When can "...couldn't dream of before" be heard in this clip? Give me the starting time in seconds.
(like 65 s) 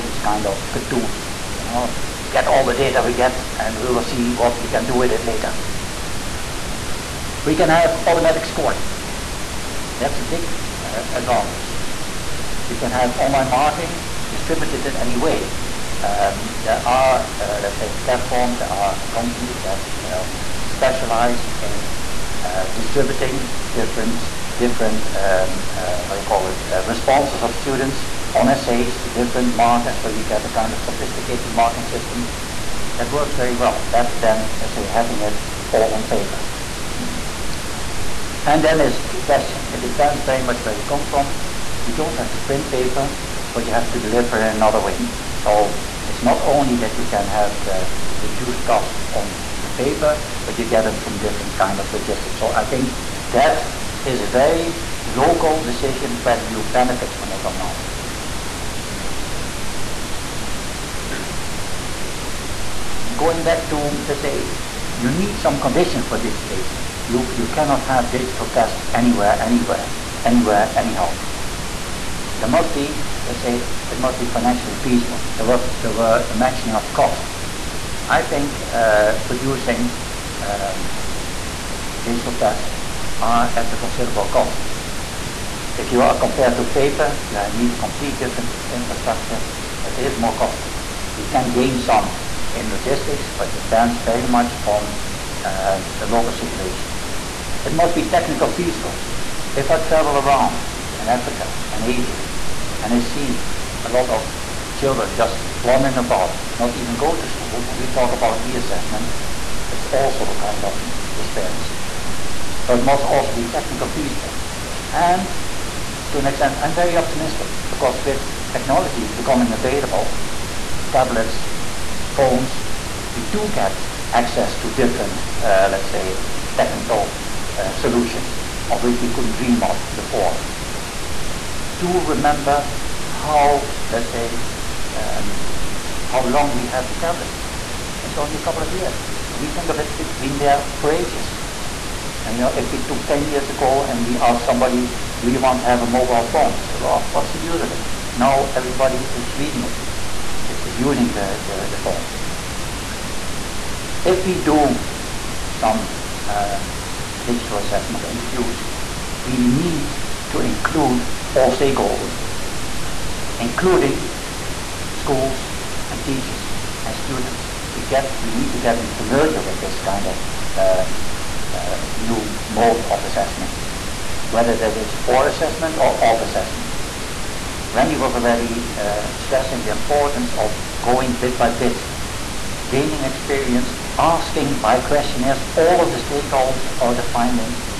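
129 s.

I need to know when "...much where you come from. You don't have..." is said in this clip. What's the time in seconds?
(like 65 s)
40 s.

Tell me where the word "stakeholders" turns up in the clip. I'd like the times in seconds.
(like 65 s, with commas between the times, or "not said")
161 s, 186 s.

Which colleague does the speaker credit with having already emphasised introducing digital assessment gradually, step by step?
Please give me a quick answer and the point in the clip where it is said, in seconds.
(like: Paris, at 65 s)
Randy, at 177 s.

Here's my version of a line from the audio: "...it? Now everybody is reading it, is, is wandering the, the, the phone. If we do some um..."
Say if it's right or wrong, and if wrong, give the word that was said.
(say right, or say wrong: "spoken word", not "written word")
wrong: "using", not "wandering".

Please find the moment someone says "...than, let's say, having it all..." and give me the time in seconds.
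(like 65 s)
34 s.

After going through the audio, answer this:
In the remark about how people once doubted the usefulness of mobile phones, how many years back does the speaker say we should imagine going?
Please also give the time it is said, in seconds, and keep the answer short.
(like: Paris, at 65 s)
10 years, at 143 s.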